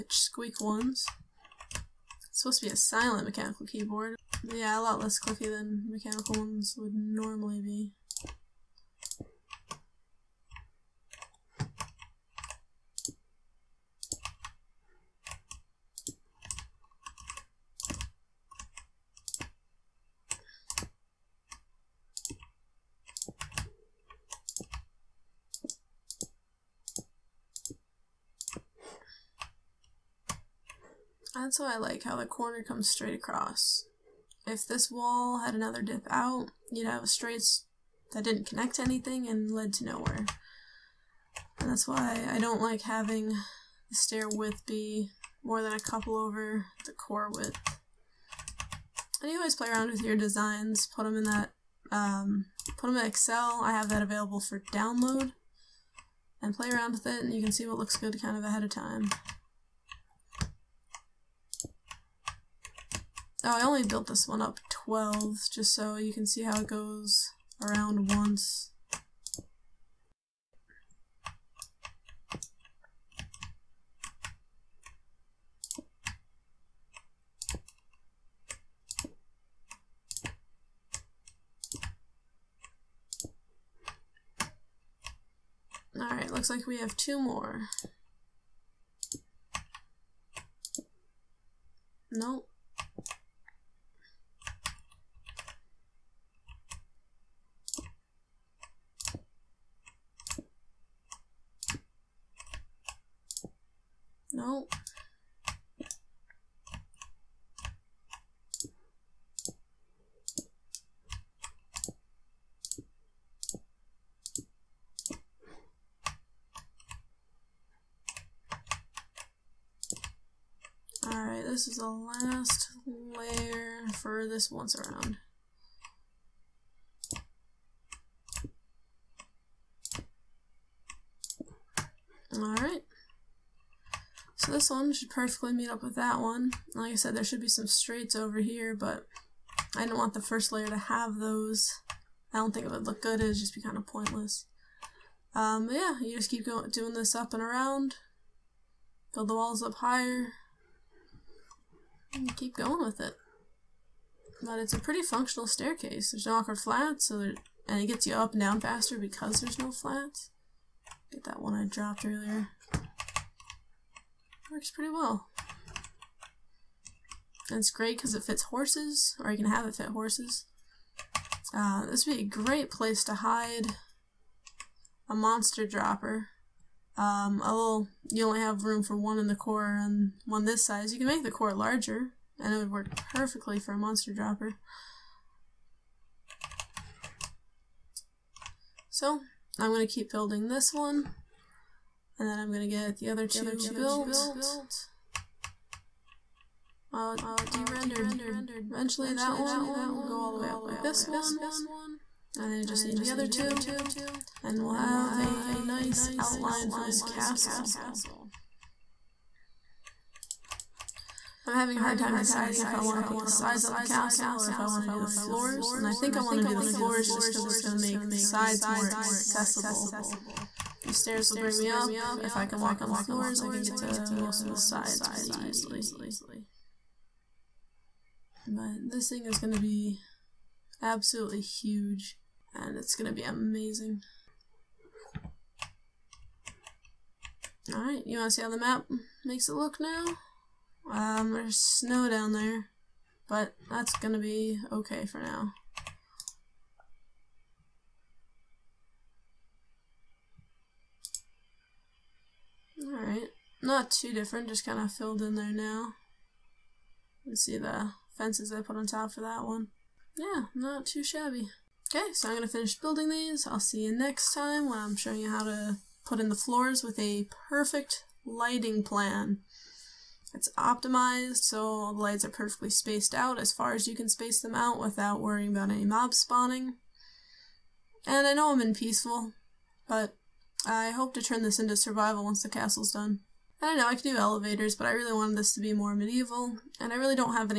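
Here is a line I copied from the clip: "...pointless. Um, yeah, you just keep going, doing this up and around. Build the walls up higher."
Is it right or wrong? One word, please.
right.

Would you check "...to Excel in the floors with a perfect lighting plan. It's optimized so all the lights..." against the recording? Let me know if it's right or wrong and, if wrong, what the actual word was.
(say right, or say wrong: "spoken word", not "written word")
wrong: "Put", not "Excel".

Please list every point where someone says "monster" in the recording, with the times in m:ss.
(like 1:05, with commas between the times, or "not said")
2:55, 3:03.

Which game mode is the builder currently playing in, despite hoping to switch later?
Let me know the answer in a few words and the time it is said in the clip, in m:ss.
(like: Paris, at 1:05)
peaceful, at 4:38.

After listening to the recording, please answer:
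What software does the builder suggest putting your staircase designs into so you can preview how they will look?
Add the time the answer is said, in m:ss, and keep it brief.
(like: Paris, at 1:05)
Excel, at 0:53.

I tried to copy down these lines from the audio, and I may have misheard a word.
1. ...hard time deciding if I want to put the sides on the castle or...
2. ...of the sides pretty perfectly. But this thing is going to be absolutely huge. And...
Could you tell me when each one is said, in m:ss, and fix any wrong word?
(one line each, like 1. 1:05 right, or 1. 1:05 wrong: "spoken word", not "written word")
1. 3:31 right
2. 3:44 wrong: "easily", not "perfectly".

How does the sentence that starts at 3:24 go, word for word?
And we'll have a nice outline for this castle.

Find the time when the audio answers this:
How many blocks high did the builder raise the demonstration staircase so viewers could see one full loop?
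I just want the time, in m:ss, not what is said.
1:04.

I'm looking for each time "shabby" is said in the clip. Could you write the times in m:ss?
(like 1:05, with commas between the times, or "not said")
4:21.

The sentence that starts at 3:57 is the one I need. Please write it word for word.
Alright, you want to see how the map makes it look now?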